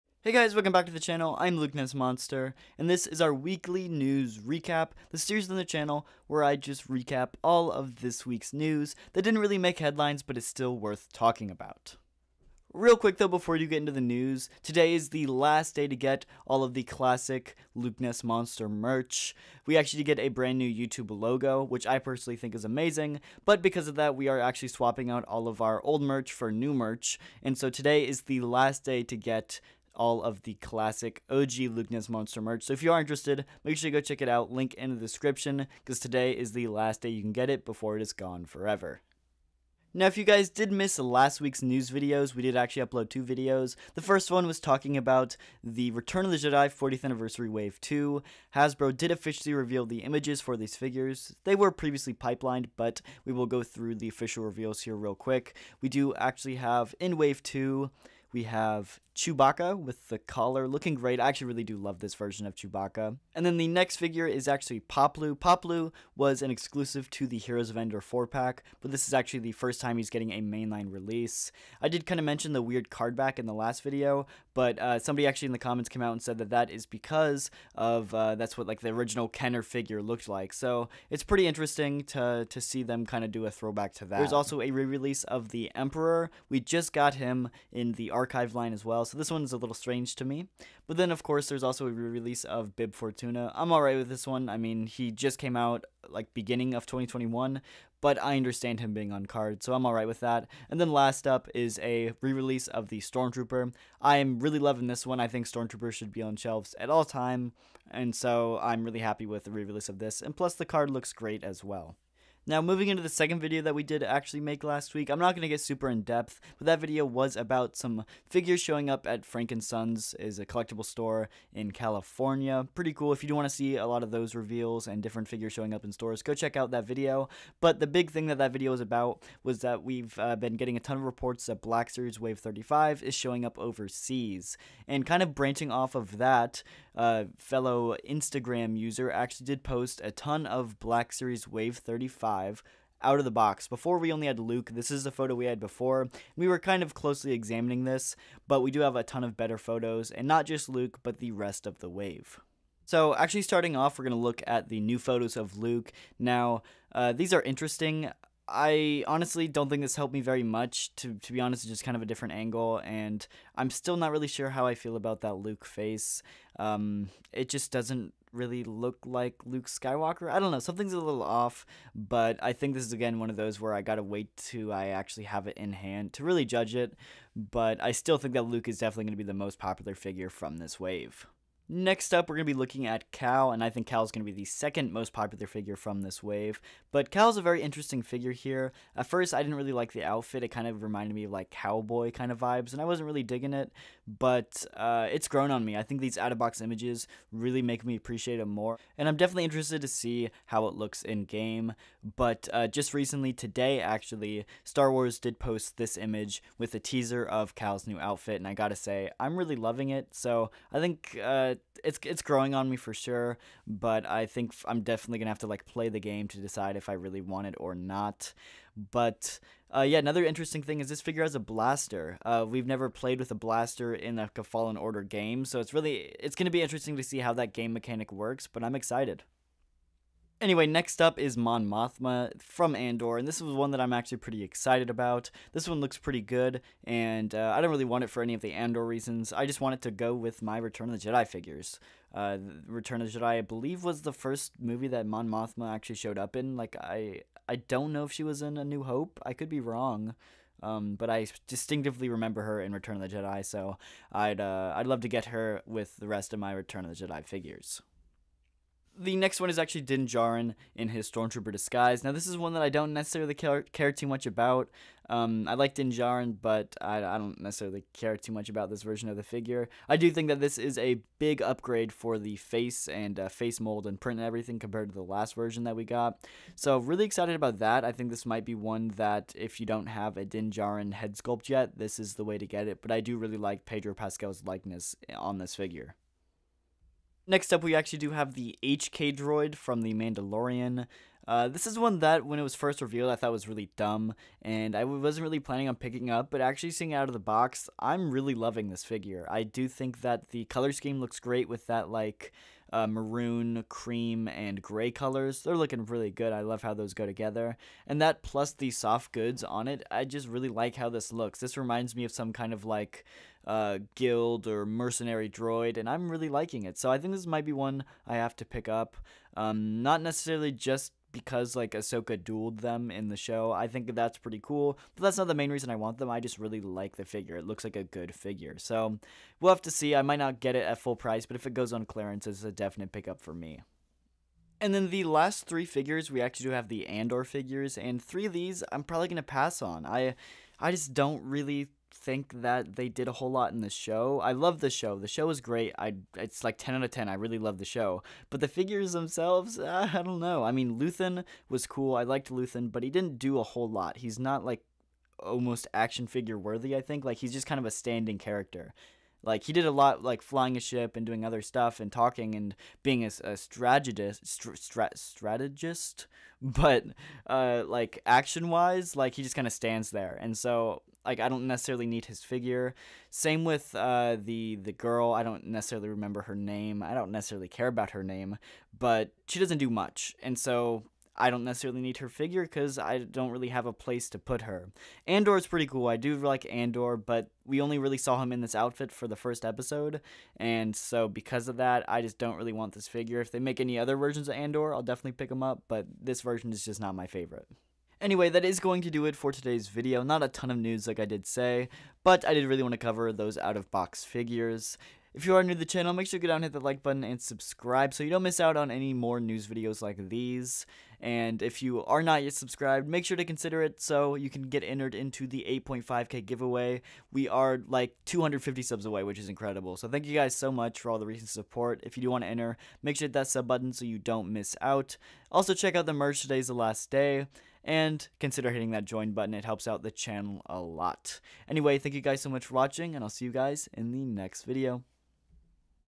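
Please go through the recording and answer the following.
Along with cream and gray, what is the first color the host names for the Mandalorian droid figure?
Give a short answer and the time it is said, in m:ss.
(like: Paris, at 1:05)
Maroon, at 5:02.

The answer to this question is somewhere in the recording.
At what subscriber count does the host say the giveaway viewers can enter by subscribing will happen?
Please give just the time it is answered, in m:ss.
6:55.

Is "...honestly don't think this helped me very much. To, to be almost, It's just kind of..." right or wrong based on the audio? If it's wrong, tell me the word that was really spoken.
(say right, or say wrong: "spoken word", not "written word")
wrong: "honest", not "almost".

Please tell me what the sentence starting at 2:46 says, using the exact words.
Um, it just doesn't really look like Luke Skywalker.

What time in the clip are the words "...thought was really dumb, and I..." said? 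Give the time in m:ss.
4:53.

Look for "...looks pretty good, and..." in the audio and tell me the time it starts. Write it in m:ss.
3:55.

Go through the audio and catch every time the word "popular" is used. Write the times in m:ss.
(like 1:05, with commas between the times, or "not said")
2:59, 3:05.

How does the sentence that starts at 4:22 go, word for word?
Now, this is one that I don't necessarily care, care too much about.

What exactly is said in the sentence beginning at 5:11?
This reminds me of some kind of like uh, guild or mercenary droid, and I'm really liking it.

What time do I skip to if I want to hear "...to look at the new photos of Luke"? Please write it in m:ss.
2:34.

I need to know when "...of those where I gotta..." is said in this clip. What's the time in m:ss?
2:53.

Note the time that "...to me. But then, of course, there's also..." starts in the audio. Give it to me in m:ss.
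1:30.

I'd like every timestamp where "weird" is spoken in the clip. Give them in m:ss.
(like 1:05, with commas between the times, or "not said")
1:12.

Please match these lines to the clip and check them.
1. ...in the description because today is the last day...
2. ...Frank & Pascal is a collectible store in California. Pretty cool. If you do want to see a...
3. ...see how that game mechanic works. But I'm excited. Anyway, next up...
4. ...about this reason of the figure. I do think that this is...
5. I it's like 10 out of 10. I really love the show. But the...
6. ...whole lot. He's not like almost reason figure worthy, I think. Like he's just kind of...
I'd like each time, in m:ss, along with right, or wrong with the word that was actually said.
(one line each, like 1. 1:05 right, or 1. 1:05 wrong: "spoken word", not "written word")
1. 0:34 right
2. 1:59 wrong: "Sons", not "Pascal"
3. 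3:47 right
4. 4:28 wrong: "version", not "reason"
5. 5:45 right
6. 5:53 wrong: "action", not "reason".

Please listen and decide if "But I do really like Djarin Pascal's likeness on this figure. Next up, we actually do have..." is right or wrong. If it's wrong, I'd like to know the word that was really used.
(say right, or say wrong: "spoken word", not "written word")
wrong: "Pedro", not "Djarin".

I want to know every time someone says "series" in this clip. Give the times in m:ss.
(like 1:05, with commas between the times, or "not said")
0:05, 2:11, 2:21.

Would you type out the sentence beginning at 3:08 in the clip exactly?
At first, I didn't really like the outfit.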